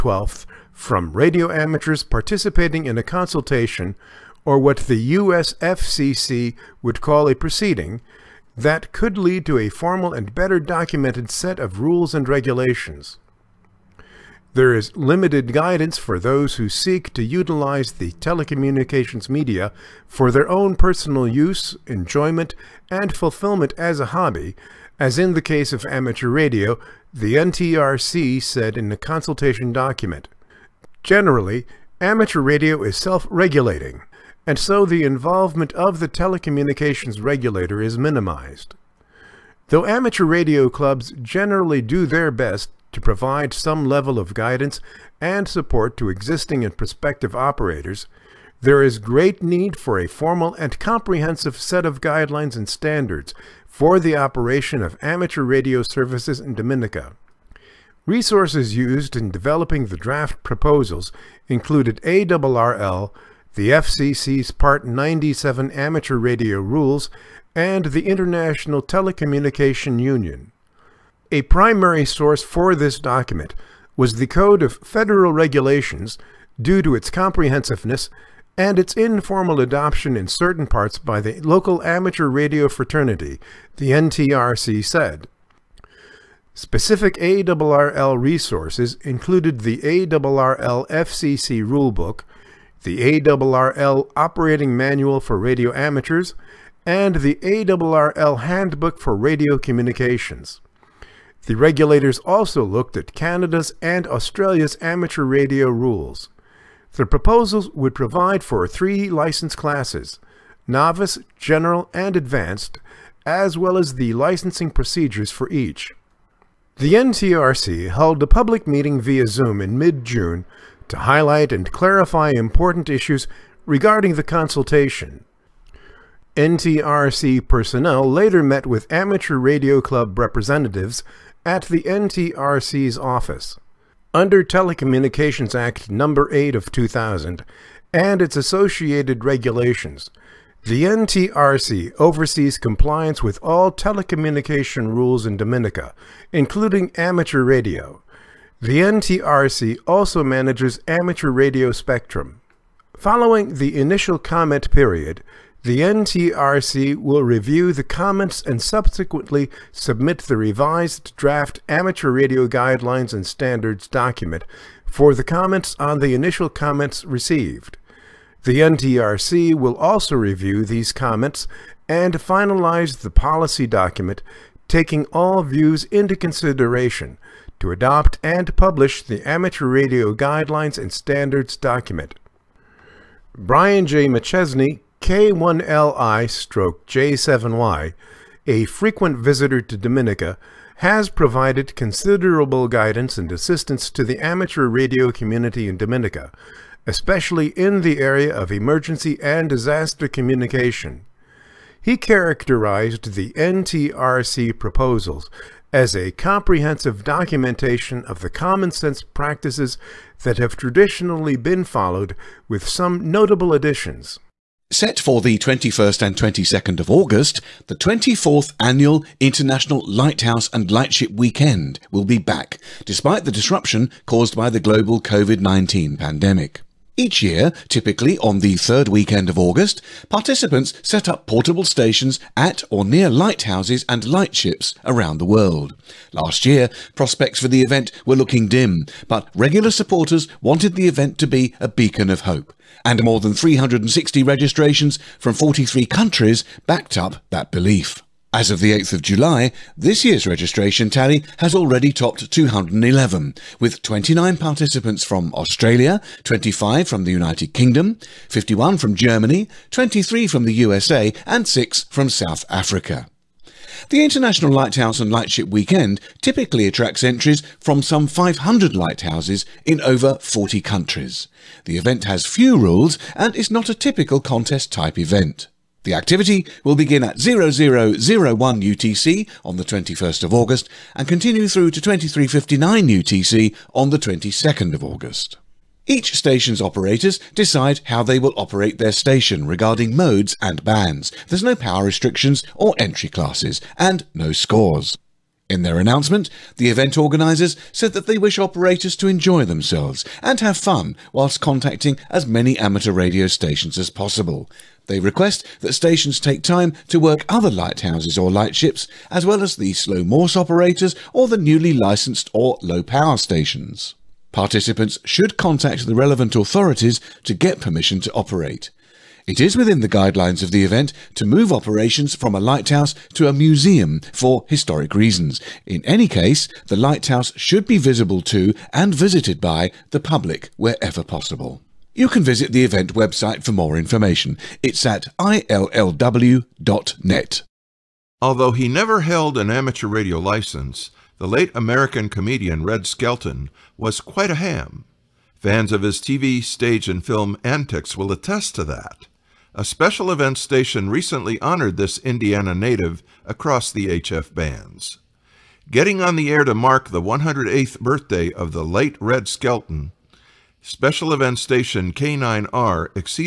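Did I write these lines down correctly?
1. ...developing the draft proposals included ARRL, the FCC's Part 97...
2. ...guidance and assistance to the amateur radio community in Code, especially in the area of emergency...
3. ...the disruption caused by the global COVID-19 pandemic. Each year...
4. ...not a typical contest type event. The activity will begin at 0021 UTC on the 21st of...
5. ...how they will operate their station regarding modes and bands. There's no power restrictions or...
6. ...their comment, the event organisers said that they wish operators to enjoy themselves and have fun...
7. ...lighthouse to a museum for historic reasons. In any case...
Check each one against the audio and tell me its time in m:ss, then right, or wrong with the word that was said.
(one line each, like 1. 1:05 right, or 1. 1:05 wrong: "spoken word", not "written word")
1. 0:59 right
2. 3:12 wrong: "Dominica", not "Code"
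3. 3:43 right
4. 4:33 wrong: "0001", not "0021"
5. 4:47 right
6. 4:55 wrong: "announcement", not "comment"
7. 5:22 right.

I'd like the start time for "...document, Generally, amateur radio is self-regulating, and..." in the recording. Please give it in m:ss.
0:29.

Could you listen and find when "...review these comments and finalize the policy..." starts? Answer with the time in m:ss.
2:50.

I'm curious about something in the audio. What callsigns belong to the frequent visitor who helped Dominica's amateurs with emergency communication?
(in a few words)
K1LI/J7Y.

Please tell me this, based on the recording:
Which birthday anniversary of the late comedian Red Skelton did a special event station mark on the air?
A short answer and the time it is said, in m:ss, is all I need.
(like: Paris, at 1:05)
108th, at 5:57.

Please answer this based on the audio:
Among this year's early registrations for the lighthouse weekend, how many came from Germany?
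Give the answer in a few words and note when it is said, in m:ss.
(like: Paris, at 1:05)
51, at 4:18.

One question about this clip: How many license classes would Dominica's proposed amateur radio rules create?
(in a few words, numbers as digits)
3.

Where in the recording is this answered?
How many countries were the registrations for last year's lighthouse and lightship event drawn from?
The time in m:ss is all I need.
4:05.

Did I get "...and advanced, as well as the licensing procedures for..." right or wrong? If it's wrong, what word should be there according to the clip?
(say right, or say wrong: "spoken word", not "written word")
right.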